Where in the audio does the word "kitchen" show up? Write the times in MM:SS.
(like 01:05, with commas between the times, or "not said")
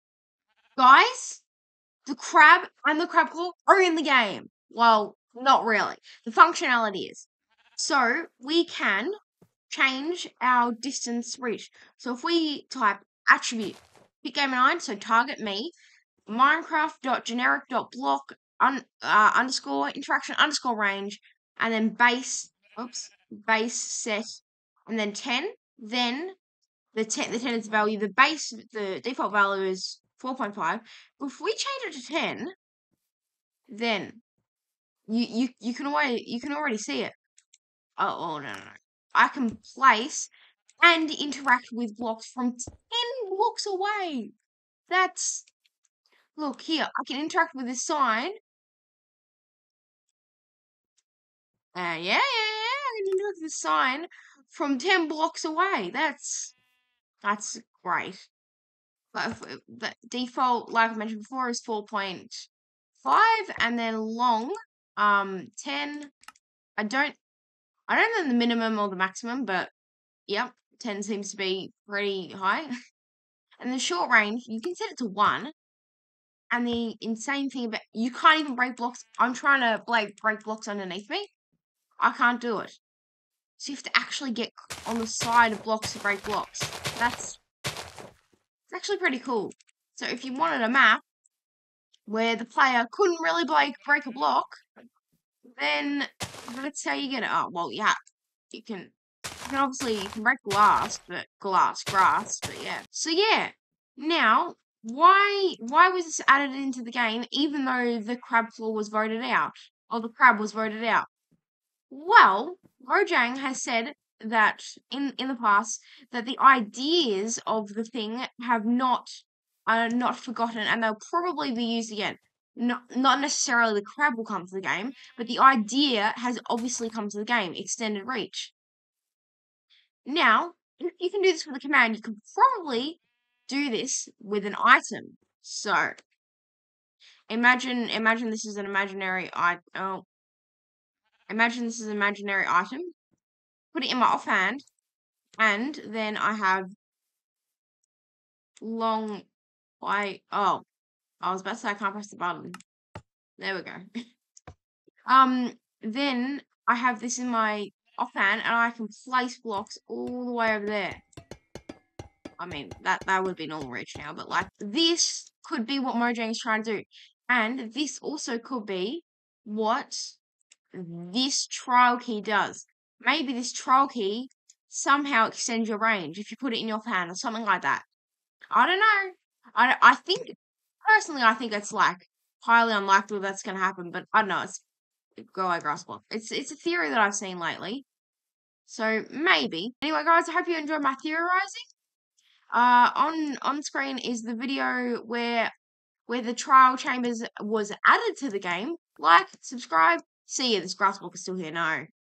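not said.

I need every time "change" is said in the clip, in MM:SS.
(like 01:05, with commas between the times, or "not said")
00:09, 00:31.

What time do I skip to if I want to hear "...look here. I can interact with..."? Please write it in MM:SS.
00:46.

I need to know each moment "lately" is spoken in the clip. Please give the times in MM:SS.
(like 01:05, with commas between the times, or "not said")
03:07.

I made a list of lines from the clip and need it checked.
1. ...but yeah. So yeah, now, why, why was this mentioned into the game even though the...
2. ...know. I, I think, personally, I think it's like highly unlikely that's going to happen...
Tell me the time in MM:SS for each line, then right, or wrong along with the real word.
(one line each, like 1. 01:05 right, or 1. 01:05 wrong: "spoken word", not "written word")
1. 01:42 wrong: "added", not "mentioned"
2. 02:58 right.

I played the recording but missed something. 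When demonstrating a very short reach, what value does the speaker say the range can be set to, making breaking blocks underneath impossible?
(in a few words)
1.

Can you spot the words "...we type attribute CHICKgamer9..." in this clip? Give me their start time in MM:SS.
00:12.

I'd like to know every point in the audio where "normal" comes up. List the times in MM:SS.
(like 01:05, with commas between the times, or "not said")
02:43.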